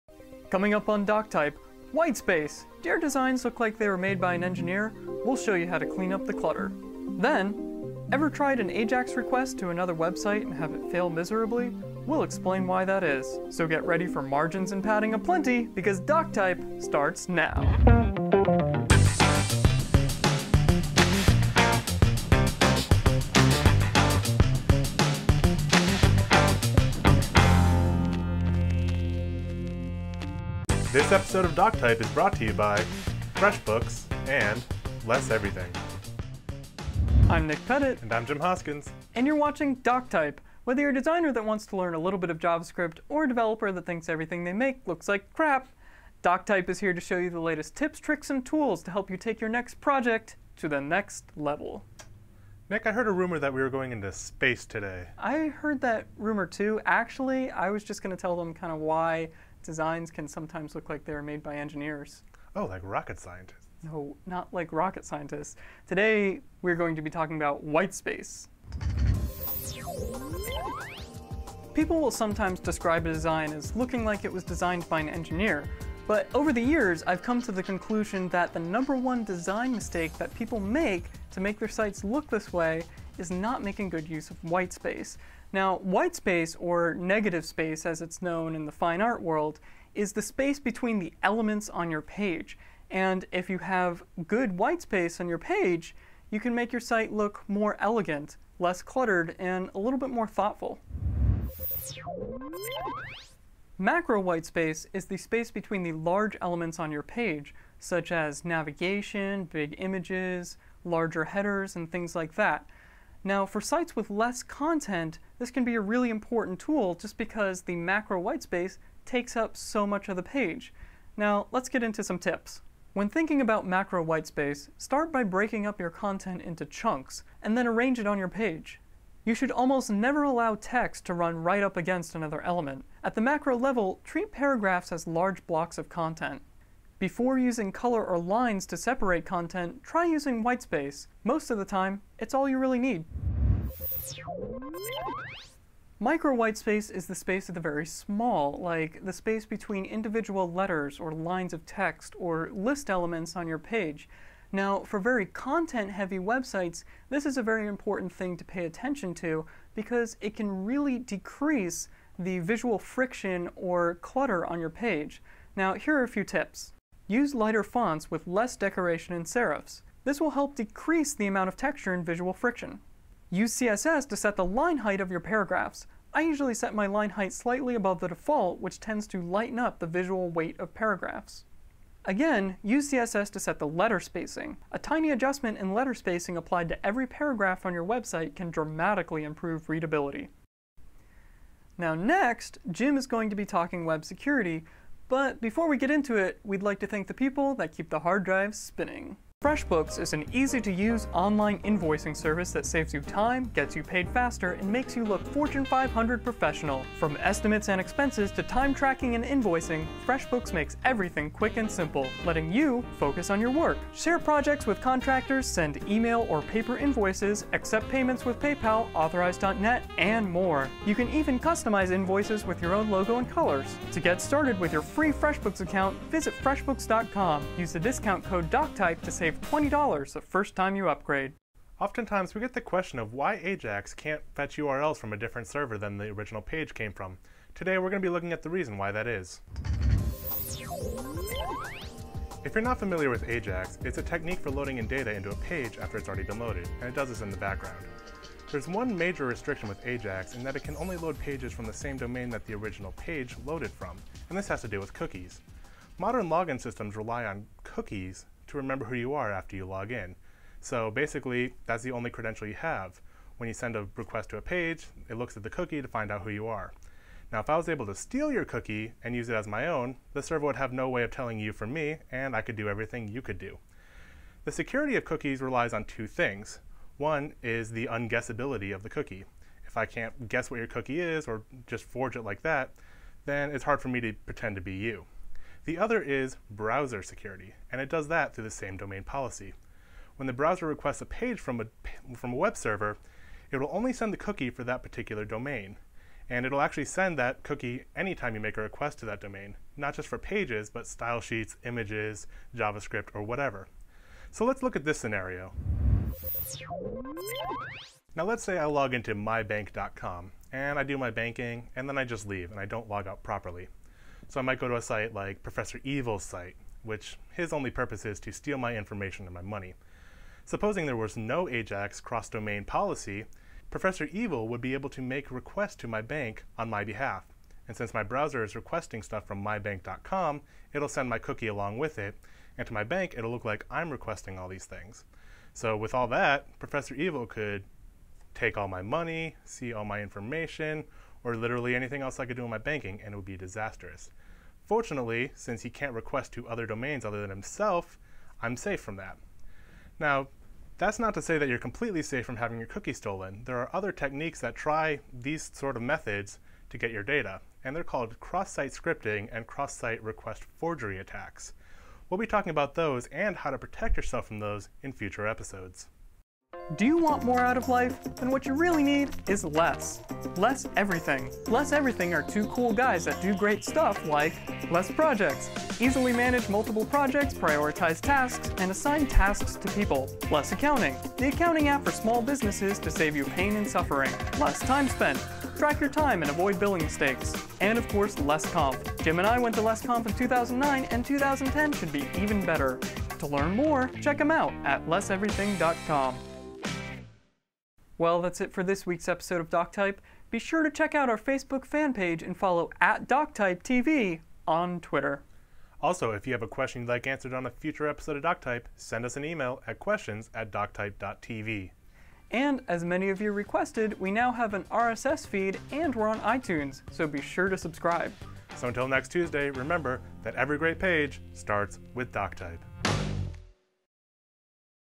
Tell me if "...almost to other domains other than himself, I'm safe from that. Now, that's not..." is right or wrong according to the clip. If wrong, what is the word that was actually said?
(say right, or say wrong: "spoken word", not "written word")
wrong: "request", not "almost".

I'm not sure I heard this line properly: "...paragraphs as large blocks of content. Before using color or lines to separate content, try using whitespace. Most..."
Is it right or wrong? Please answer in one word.
right.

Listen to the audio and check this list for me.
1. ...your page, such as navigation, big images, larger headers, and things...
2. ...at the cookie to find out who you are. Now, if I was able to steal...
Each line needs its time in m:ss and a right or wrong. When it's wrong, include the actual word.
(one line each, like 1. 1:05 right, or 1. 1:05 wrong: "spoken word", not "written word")
1. 1:46 right
2. 4:25 right.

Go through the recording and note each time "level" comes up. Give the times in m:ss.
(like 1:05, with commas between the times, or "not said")
0:51, 2:13.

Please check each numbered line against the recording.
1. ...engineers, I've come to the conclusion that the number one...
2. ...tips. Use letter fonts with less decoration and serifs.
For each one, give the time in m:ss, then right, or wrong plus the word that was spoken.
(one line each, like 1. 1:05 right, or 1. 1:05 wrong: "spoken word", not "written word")
1. 1:16 wrong: "years", not "engineers"
2. 2:46 wrong: "lighter", not "letter".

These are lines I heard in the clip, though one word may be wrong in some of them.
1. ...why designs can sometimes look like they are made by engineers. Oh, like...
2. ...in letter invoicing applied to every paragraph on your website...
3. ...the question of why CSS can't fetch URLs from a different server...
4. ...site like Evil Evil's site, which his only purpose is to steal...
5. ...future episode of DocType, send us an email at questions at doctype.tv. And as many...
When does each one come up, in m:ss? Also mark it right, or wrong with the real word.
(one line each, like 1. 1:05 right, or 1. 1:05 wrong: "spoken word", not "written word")
1. 0:58 right
2. 3:05 wrong: "spacing", not "invoicing"
3. 3:52 wrong: "Ajax", not "CSS"
4. 5:14 wrong: "Professor", not "Evil"
5. 6:47 right.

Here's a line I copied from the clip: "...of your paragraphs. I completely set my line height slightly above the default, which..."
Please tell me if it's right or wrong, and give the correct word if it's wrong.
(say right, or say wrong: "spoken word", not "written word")
wrong: "usually", not "completely".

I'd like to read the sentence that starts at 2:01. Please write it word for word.
Now, let's get into some tips.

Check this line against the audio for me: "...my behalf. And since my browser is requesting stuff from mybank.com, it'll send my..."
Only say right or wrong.
right.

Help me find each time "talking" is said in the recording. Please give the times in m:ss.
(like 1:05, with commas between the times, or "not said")
1:07, 3:13, 6:02.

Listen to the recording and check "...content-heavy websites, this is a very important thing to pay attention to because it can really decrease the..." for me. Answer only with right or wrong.
right.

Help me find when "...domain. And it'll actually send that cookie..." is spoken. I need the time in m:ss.
4:55.